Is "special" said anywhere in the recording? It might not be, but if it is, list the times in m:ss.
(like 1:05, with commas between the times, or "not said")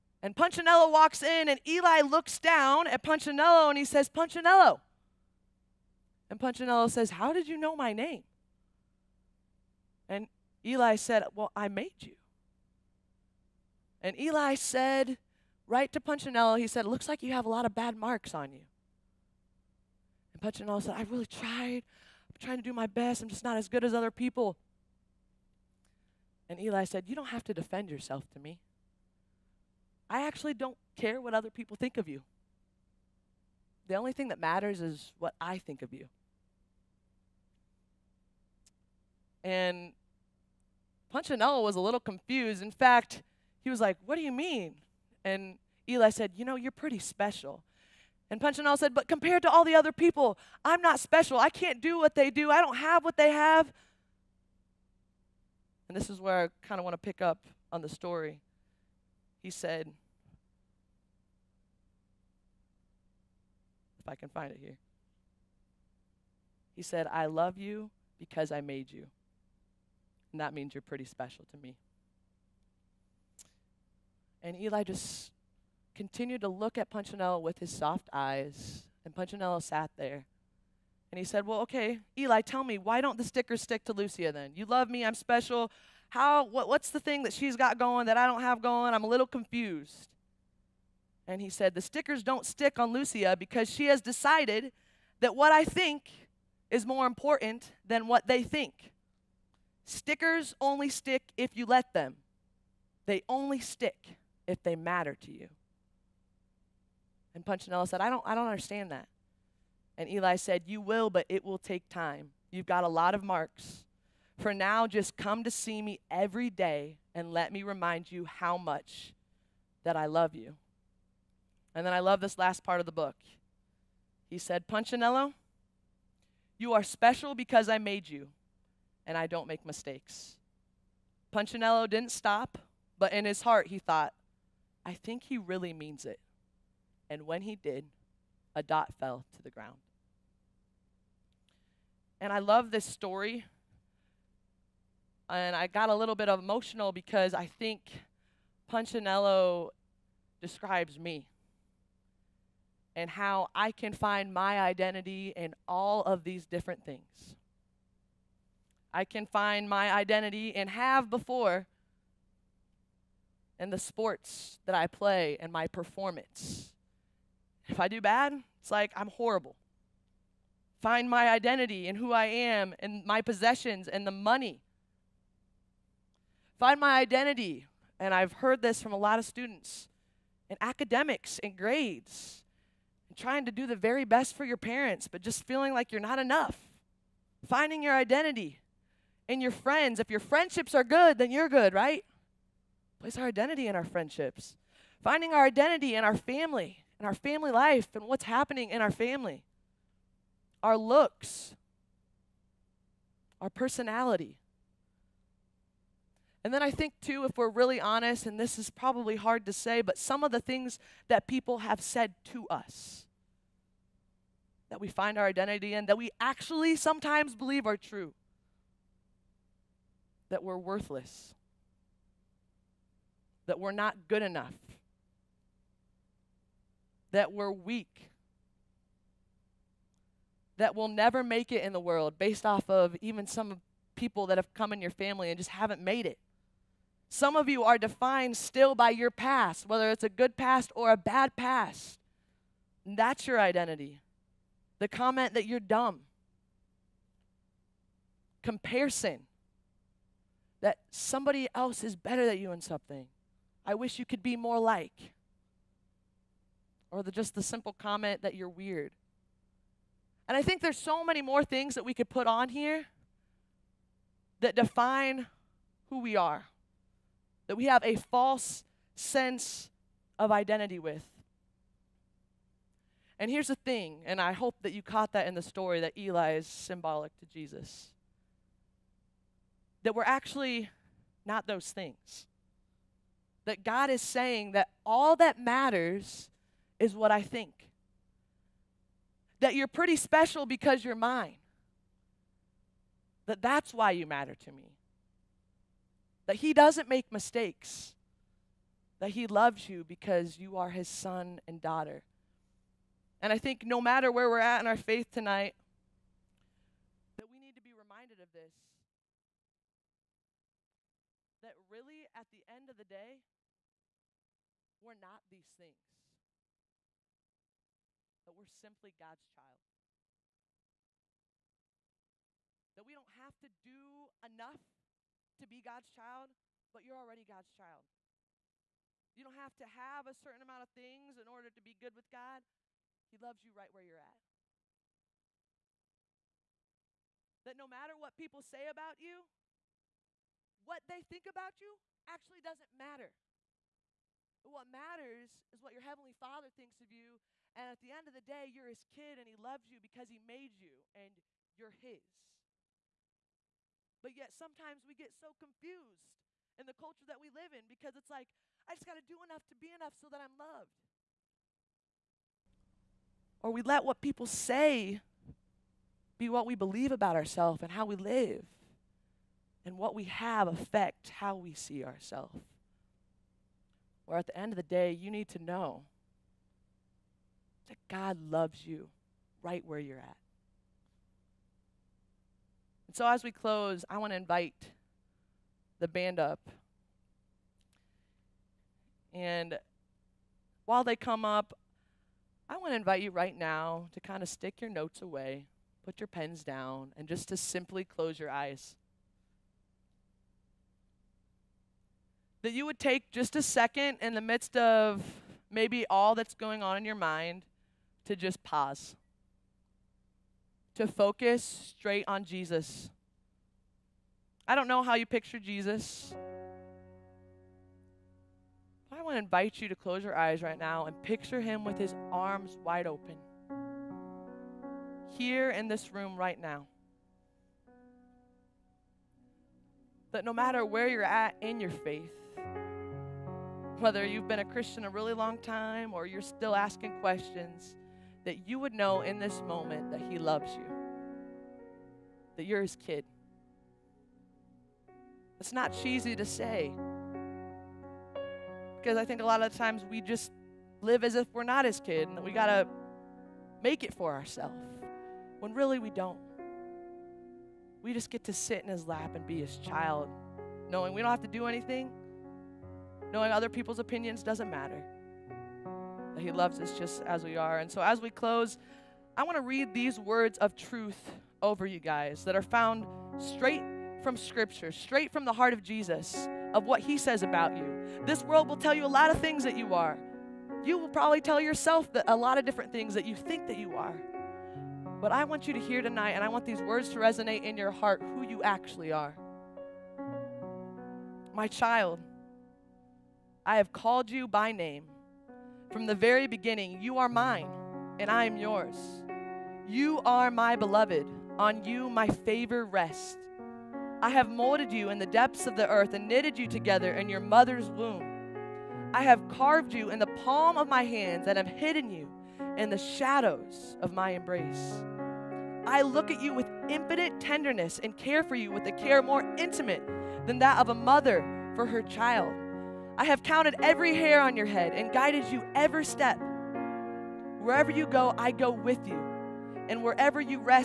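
0:46, 0:51, 1:11, 1:25, 2:06, 4:49.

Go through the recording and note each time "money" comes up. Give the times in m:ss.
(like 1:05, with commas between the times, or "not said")
2:54.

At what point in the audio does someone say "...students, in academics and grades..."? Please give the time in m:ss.
2:59.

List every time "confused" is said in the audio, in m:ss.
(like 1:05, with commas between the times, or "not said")
0:42, 1:29, 5:55.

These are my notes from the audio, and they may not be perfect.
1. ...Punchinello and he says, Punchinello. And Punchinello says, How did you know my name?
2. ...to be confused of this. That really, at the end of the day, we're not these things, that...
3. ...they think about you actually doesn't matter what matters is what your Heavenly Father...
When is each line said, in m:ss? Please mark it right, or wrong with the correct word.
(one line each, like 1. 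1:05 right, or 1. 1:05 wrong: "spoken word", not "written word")
1. 0:03 right
2. 5:07 wrong: "reminded", not "confused"
3. 5:40 right.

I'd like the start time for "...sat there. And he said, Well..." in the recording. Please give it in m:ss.
1:19.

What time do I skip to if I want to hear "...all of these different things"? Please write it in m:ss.
2:35.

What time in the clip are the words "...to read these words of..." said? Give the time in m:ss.
7:49.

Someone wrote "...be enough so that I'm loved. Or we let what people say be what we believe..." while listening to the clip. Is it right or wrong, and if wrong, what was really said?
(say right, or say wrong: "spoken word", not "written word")
right.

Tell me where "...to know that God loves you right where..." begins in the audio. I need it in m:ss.
6:15.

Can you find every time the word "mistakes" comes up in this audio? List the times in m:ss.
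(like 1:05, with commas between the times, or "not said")
2:09, 4:57.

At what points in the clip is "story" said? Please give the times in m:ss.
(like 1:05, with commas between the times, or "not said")
0:57, 2:22, 4:35.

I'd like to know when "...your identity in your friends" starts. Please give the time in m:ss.
3:07.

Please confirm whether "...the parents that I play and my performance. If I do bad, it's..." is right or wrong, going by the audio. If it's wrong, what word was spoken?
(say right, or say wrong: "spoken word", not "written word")
wrong: "sports", not "parents".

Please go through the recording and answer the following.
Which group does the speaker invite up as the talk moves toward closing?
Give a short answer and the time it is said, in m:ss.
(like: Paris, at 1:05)
The band, at 6:25.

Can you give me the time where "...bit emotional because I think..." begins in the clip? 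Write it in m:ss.
2:26.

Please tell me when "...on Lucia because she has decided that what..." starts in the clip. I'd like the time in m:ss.
1:32.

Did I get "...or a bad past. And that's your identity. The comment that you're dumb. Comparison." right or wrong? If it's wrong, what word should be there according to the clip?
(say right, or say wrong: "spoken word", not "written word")
right.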